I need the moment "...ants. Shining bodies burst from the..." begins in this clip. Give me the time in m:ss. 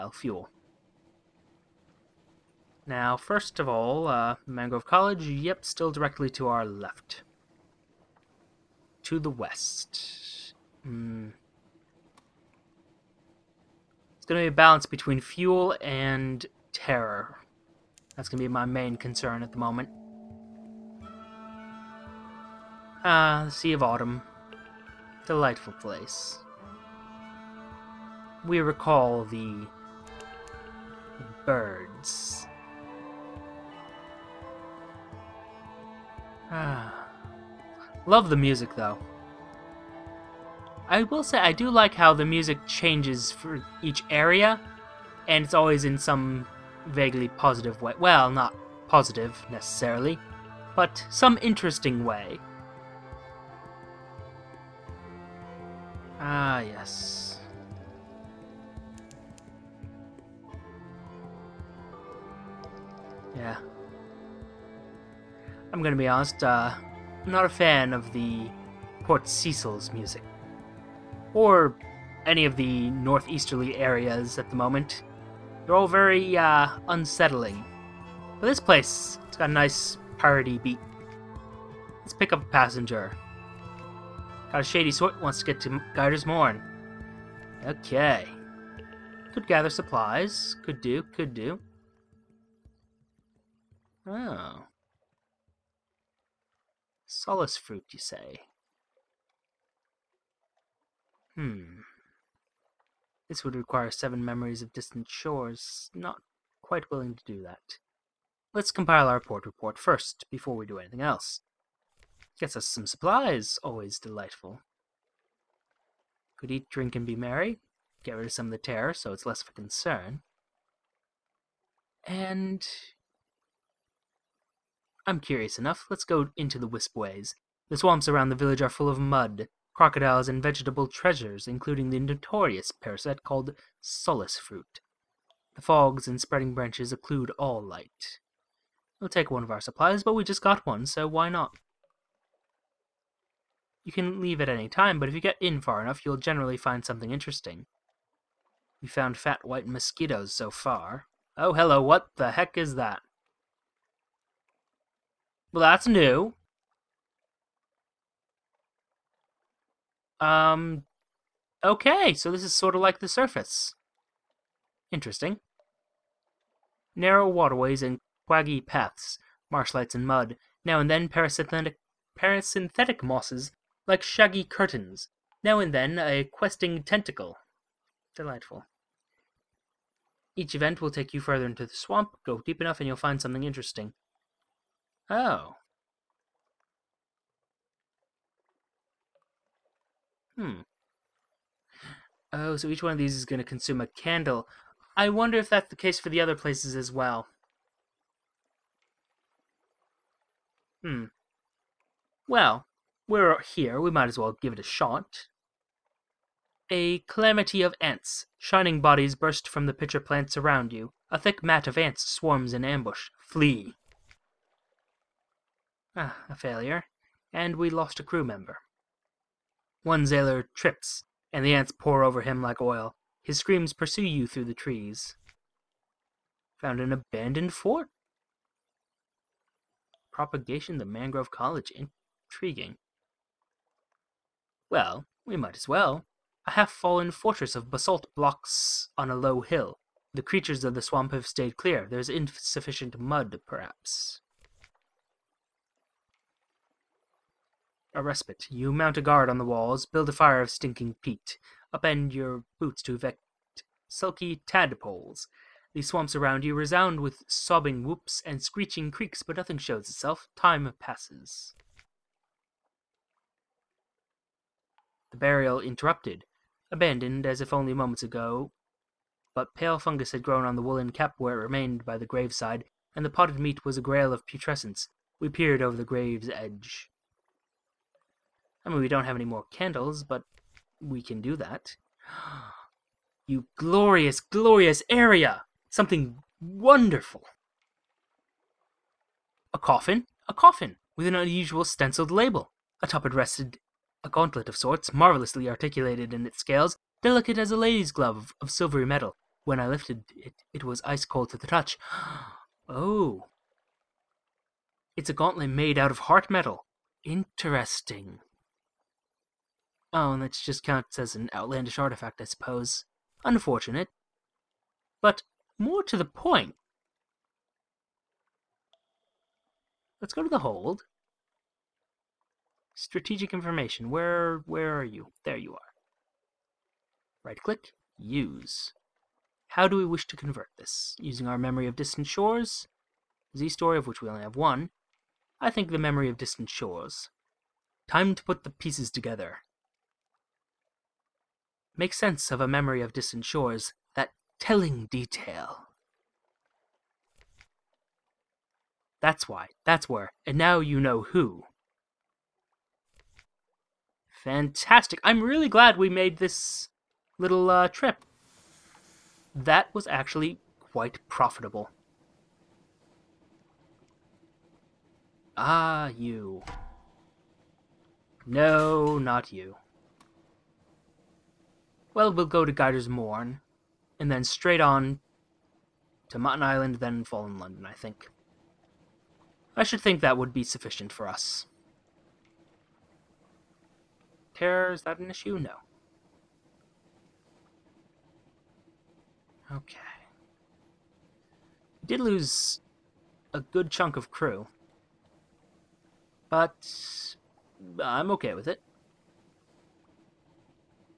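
3:27.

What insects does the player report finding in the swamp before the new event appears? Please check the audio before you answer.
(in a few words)
fat white mosquitoes.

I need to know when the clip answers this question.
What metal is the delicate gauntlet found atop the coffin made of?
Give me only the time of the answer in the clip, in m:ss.
5:05.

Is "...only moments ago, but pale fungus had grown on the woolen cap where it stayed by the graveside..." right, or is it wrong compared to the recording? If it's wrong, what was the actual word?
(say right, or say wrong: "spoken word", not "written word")
wrong: "remained", not "stayed".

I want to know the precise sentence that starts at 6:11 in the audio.
Well, we'll go to Gaider's Mourn, and then straight on to Mutton Island, then Fallen London, I think.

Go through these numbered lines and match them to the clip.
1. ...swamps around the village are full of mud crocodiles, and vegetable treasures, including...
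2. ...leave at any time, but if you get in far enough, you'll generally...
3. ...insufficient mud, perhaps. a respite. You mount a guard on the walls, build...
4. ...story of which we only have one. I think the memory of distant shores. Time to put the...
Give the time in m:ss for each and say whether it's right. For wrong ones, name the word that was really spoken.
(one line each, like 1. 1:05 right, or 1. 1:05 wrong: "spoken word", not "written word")
1. 2:07 right
2. 2:24 right
3. 4:02 right
4. 5:33 right.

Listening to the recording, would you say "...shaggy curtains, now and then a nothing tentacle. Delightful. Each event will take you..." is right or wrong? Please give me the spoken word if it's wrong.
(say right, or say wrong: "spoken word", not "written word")
wrong: "questing", not "nothing".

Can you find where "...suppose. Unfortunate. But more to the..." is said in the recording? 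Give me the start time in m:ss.
5:12.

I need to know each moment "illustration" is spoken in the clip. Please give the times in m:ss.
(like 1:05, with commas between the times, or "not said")
not said.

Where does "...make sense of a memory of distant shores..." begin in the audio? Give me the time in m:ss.
5:41.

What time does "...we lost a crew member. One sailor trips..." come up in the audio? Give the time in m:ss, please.
3:37.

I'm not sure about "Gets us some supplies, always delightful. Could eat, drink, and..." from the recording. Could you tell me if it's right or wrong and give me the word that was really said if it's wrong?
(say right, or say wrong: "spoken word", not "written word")
right.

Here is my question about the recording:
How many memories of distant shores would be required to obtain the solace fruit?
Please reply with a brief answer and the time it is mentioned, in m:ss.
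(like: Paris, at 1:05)
7, at 1:43.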